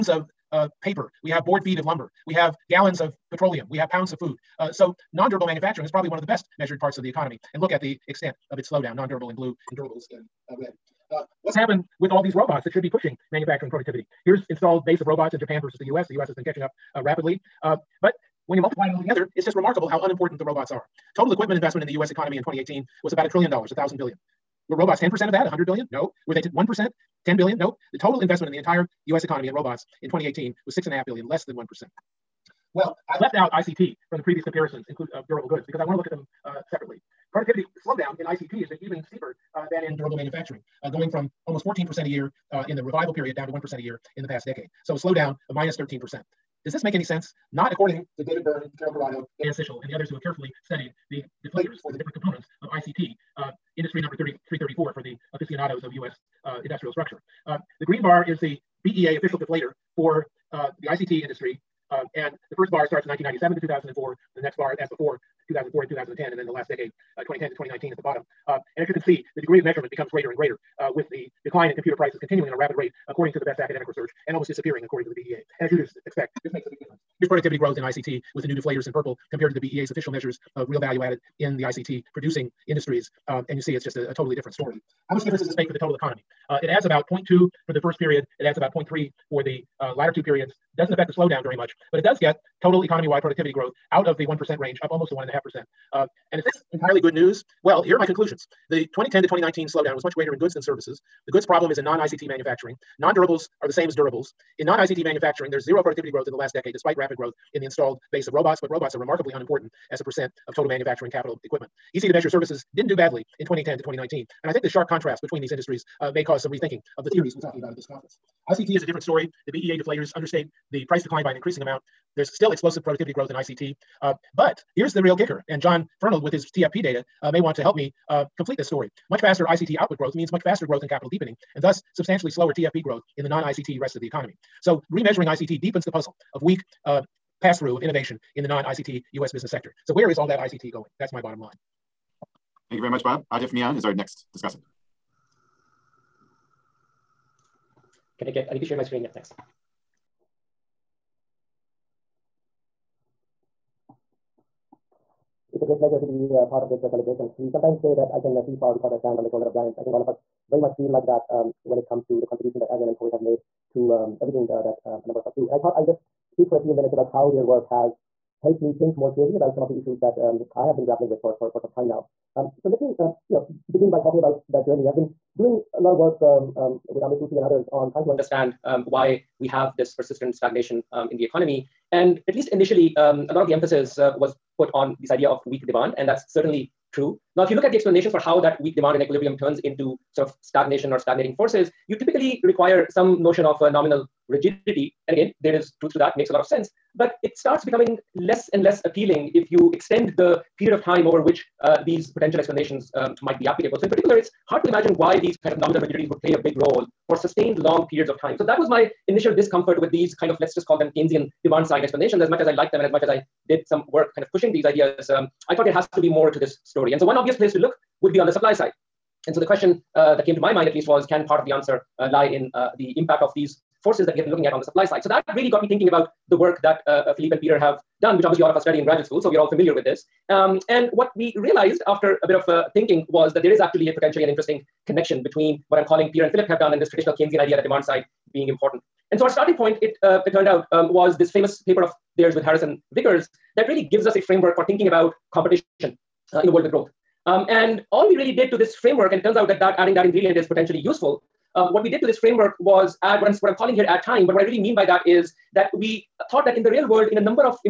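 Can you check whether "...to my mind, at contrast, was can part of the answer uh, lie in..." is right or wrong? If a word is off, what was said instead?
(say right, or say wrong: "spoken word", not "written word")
wrong: "least", not "contrast".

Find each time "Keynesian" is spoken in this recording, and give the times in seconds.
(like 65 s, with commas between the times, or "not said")
210 s, 237 s.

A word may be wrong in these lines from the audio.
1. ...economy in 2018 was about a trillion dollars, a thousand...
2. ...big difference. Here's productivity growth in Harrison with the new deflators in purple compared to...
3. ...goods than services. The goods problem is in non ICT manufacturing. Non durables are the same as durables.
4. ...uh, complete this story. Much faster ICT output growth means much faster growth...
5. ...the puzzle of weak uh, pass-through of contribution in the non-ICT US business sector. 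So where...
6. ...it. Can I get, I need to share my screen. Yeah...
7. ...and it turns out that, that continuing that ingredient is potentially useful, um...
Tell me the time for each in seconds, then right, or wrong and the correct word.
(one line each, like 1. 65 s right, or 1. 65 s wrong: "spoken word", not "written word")
1. 22 s right
2. 76 s wrong: "ICT", not "Harrison"
3. 100 s right
4. 128 s right
5. 135 s wrong: "innovation", not "contribution"
6. 144 s right
7. 249 s wrong: "adding", not "continuing".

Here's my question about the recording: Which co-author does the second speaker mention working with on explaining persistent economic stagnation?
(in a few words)
Amir Sufi.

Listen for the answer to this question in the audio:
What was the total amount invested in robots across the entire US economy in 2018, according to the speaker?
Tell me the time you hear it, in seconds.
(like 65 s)
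30 s.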